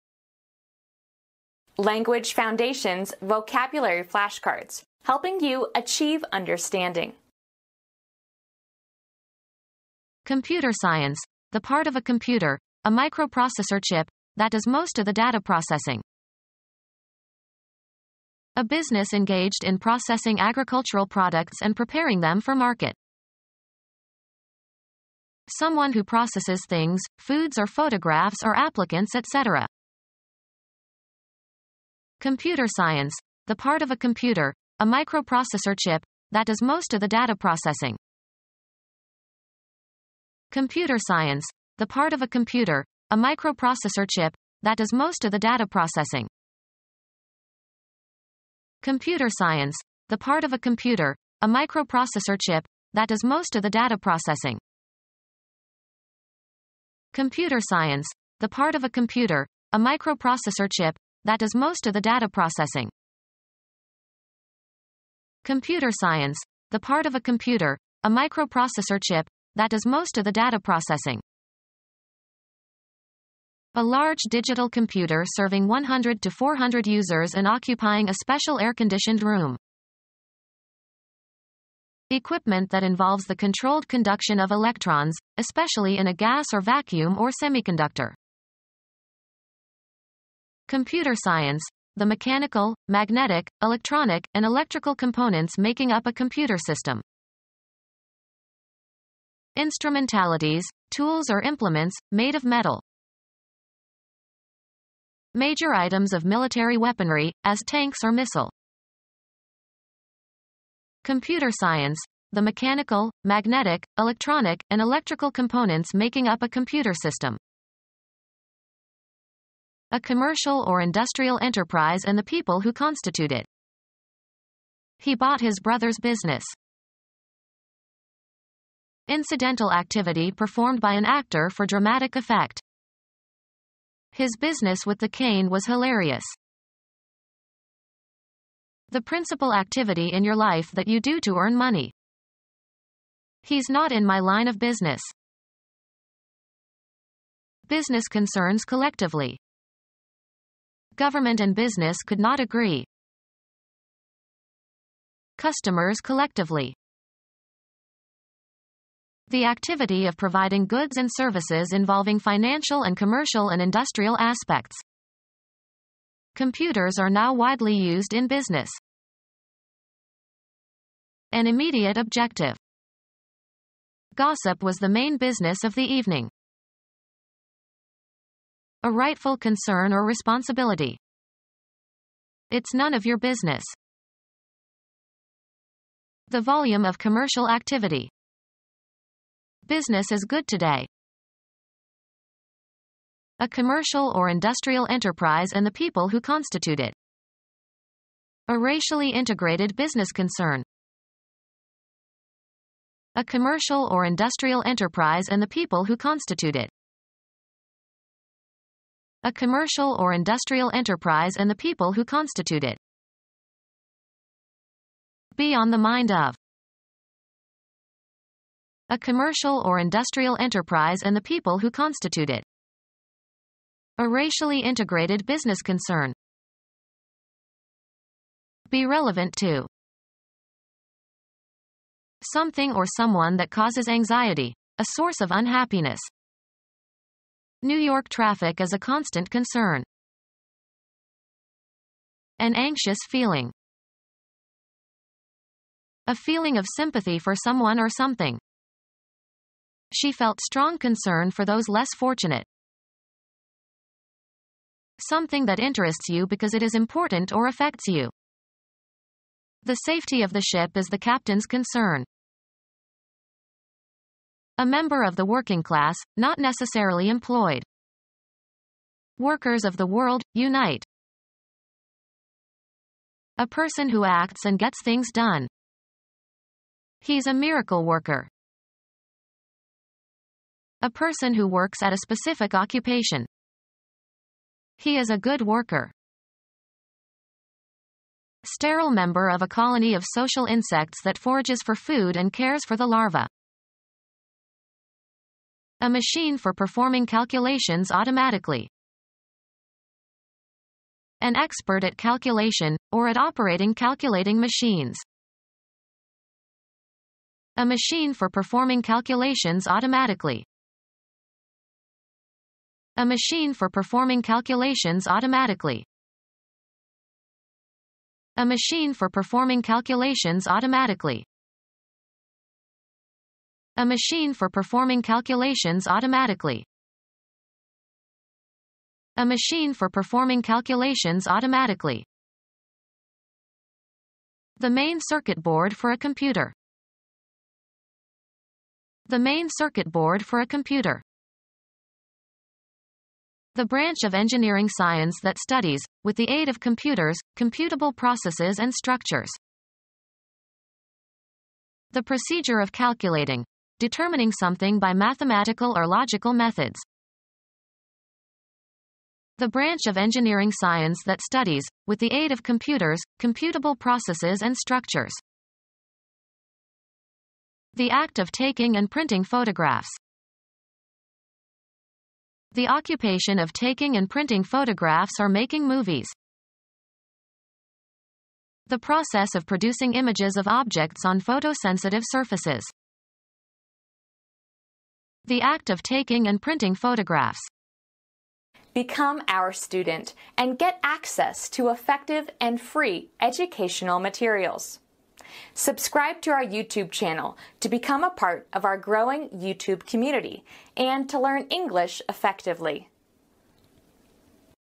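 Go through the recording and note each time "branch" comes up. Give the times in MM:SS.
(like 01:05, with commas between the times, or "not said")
05:43, 05:59.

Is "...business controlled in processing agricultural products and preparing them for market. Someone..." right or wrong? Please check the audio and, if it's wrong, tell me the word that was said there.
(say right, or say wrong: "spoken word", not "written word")
wrong: "engaged", not "controlled".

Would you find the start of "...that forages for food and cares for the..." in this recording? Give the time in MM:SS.
04:51.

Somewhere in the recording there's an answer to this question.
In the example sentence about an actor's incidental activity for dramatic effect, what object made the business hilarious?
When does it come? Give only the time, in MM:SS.
02:14.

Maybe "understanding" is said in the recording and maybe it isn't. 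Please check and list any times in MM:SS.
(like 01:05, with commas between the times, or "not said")
00:06.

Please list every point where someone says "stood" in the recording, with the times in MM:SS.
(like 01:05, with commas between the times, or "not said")
not said.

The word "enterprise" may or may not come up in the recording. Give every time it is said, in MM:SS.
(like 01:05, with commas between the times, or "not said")
02:01, 03:14, 03:24, 03:30, 03:40.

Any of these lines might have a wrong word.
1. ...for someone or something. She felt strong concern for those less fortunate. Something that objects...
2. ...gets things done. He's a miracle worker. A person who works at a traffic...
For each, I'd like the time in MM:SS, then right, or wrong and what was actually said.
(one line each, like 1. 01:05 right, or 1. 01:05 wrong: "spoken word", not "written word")
1. 04:07 wrong: "interests", not "objects"
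2. 04:34 wrong: "specific", not "traffic".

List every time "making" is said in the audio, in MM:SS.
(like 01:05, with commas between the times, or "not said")
01:35, 01:55, 06:15.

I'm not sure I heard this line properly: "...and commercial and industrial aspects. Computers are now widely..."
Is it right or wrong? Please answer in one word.
right.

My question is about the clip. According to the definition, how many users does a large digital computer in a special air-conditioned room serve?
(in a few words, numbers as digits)
100 to 400.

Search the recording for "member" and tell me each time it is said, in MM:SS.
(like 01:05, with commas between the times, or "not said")
04:24, 04:48.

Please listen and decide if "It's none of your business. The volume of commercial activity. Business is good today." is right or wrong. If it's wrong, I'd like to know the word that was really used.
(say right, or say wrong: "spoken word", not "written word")
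right.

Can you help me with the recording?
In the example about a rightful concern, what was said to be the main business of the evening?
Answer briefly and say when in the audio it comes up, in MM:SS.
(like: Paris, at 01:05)
Gossip, at 02:54.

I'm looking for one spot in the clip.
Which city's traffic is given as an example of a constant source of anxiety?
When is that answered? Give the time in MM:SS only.
03:57.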